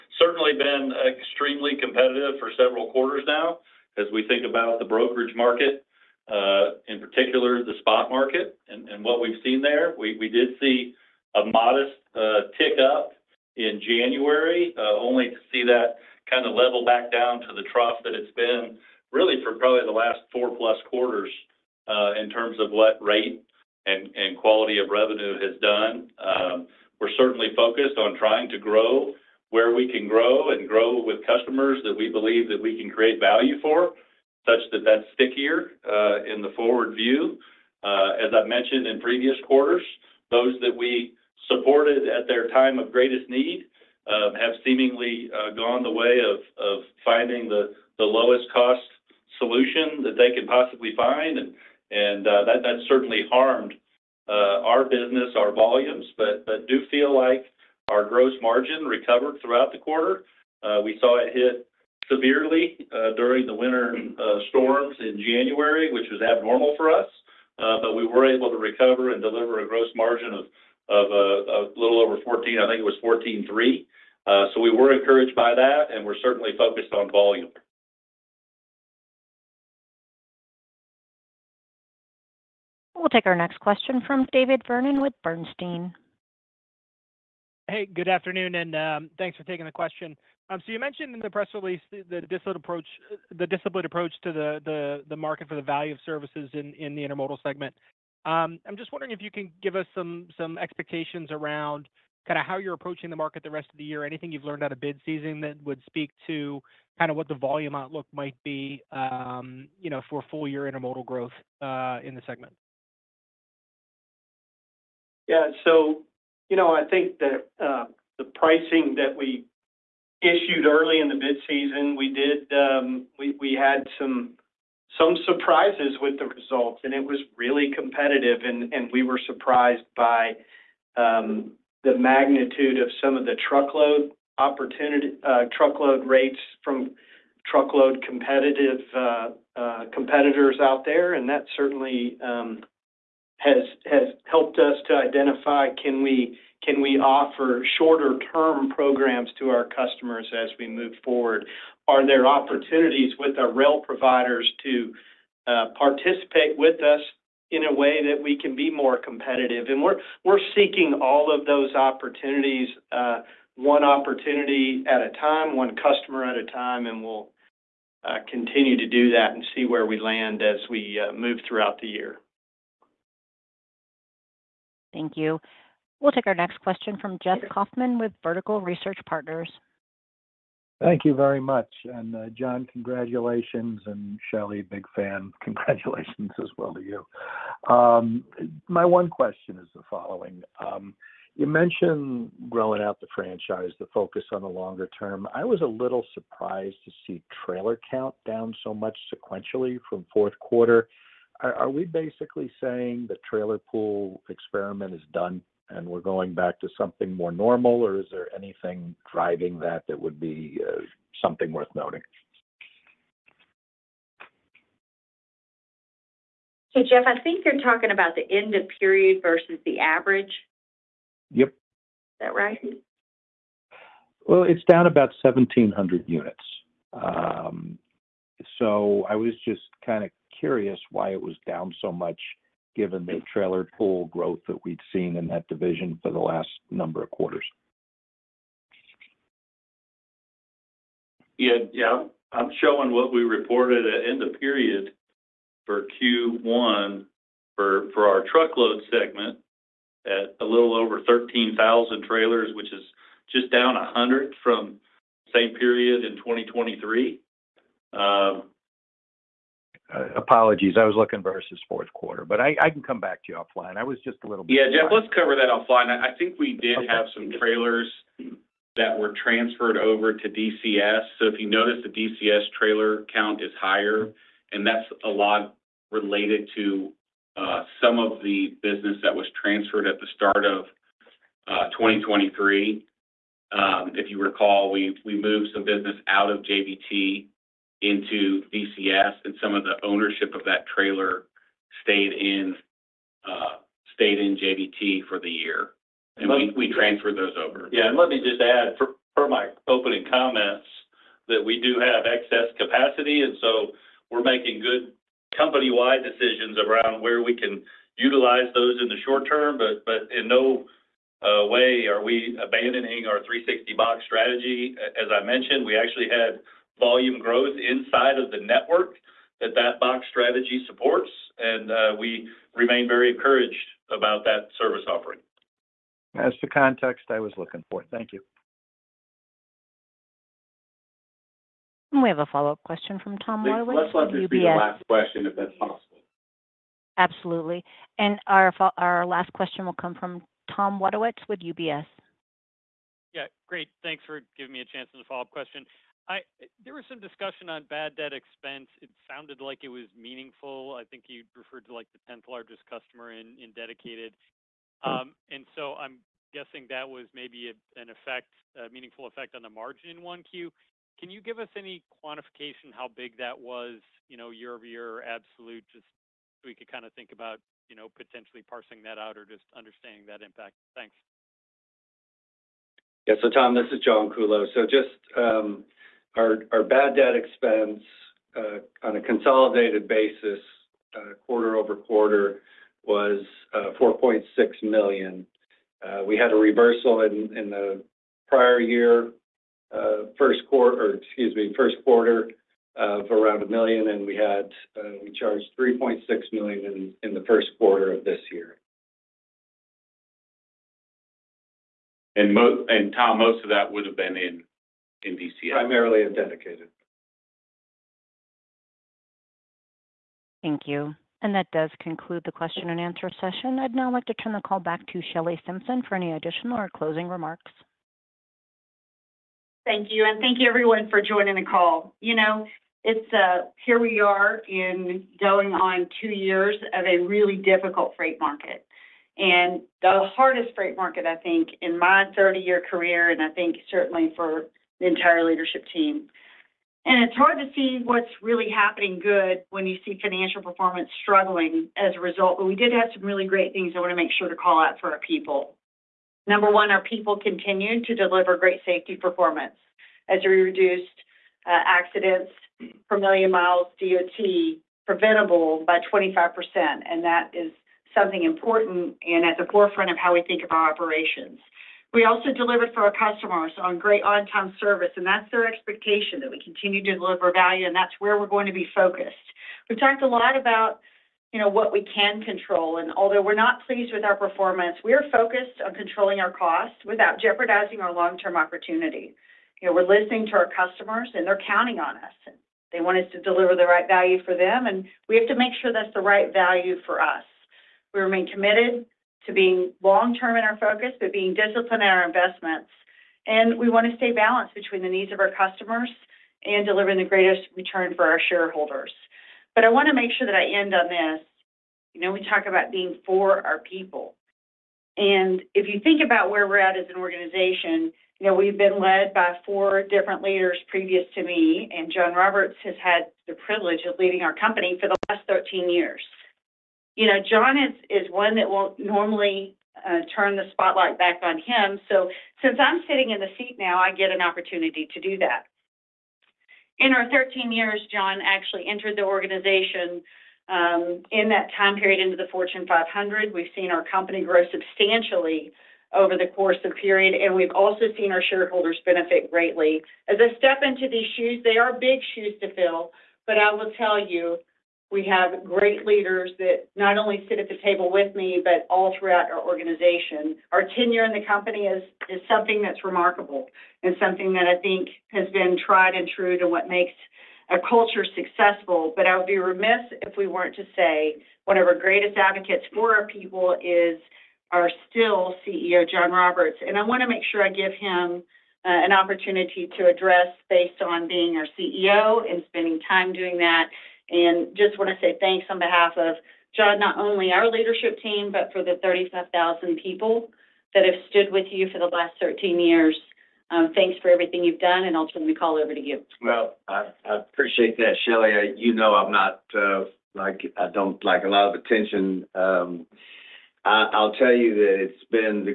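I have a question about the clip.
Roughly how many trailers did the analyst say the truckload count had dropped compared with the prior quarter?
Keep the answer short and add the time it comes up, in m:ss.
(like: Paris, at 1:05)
1,700, at 3:45.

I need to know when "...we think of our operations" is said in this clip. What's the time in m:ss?
7:40.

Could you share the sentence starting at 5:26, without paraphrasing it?
That's the context I was looking for.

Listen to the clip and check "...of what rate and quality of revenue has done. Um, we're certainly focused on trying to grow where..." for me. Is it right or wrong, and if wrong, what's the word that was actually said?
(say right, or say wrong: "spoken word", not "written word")
right.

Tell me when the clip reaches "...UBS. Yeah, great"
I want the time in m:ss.
5:41.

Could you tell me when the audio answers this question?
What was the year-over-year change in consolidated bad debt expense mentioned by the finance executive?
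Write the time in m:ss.
6:23.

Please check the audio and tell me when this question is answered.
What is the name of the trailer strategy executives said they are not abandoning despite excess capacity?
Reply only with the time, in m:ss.
5:13.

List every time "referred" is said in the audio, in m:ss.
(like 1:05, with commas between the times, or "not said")
5:51.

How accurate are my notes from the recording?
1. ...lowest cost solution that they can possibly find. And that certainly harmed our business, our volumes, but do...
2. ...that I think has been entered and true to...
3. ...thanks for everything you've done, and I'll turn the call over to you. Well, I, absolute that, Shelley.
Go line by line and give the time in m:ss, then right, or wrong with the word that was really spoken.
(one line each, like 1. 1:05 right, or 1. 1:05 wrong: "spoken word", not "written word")
1. 0:47 right
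2. 9:14 wrong: "tried", not "entered"
3. 9:43 wrong: "appreciate", not "absolute".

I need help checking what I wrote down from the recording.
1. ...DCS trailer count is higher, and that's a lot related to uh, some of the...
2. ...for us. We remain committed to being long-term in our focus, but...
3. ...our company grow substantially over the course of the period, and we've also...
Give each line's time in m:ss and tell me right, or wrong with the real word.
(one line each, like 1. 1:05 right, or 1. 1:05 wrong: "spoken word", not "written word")
1. 4:31 right
2. 8:06 right
3. 8:53 right.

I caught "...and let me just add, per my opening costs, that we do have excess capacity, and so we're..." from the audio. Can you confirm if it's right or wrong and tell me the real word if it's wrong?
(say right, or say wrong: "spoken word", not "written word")
wrong: "comments", not "costs".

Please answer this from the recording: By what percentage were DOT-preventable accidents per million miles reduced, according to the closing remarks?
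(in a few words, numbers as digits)
25%.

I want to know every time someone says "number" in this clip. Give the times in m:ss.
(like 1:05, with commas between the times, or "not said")
3:56, 7:26.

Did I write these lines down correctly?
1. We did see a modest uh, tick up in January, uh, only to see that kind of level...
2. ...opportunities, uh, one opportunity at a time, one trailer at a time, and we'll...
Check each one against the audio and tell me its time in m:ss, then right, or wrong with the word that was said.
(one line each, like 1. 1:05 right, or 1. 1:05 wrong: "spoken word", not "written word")
1. 0:09 right
2. 2:41 wrong: "customer", not "trailer".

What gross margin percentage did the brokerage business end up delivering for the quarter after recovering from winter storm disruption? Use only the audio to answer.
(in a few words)
14.3.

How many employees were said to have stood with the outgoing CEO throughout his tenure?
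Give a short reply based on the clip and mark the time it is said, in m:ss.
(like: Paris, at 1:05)
35,000, at 9:38.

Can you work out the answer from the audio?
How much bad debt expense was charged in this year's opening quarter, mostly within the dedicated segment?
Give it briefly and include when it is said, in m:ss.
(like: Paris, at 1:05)
$3.6 million, at 6:35.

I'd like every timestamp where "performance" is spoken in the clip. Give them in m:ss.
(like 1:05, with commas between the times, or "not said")
7:20, 7:28, 7:54.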